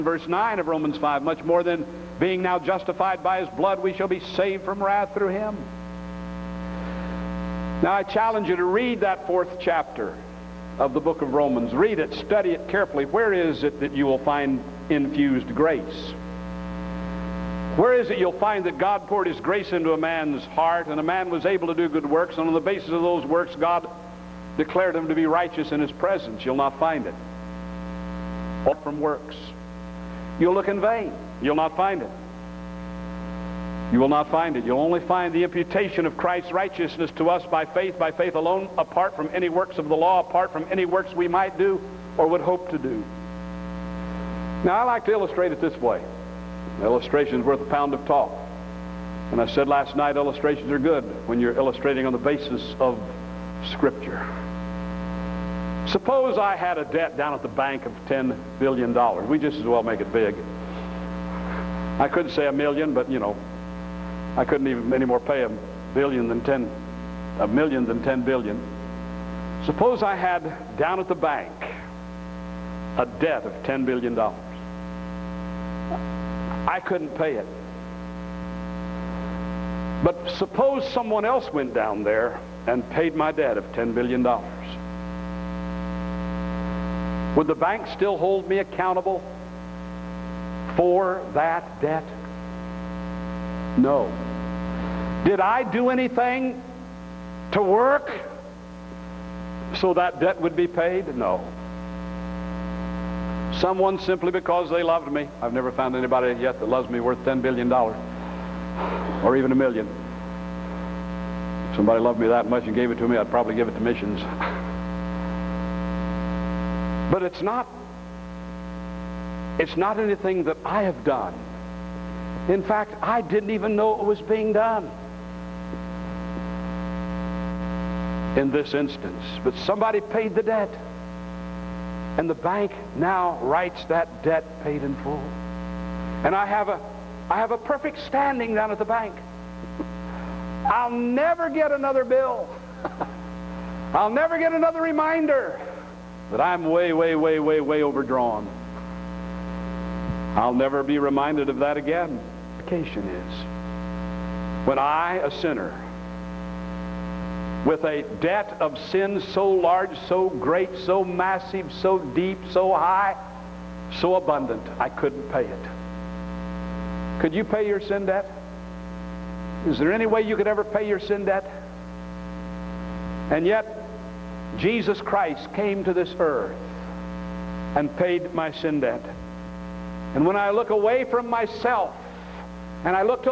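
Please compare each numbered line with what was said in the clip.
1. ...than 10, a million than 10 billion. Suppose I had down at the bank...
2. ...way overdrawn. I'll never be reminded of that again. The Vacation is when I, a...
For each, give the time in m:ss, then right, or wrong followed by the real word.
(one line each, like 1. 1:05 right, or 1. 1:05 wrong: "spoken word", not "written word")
1. 1:06 right
2. 2:27 right.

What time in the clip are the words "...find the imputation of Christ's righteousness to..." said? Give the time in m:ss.
0:34.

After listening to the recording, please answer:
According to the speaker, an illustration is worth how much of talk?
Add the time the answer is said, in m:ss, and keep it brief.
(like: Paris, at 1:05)
a pound, at 0:47.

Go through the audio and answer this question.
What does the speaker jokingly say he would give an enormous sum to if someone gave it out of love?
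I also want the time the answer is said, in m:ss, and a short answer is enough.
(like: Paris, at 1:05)
missions, at 1:53.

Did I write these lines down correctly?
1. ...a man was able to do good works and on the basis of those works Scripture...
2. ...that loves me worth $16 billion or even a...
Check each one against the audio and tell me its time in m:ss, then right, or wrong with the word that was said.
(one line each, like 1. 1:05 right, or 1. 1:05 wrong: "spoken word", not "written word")
1. 0:20 wrong: "God", not "Scripture"
2. 1:46 wrong: "10", not "16".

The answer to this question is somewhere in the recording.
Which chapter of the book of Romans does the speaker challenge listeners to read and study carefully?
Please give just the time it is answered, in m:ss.
0:09.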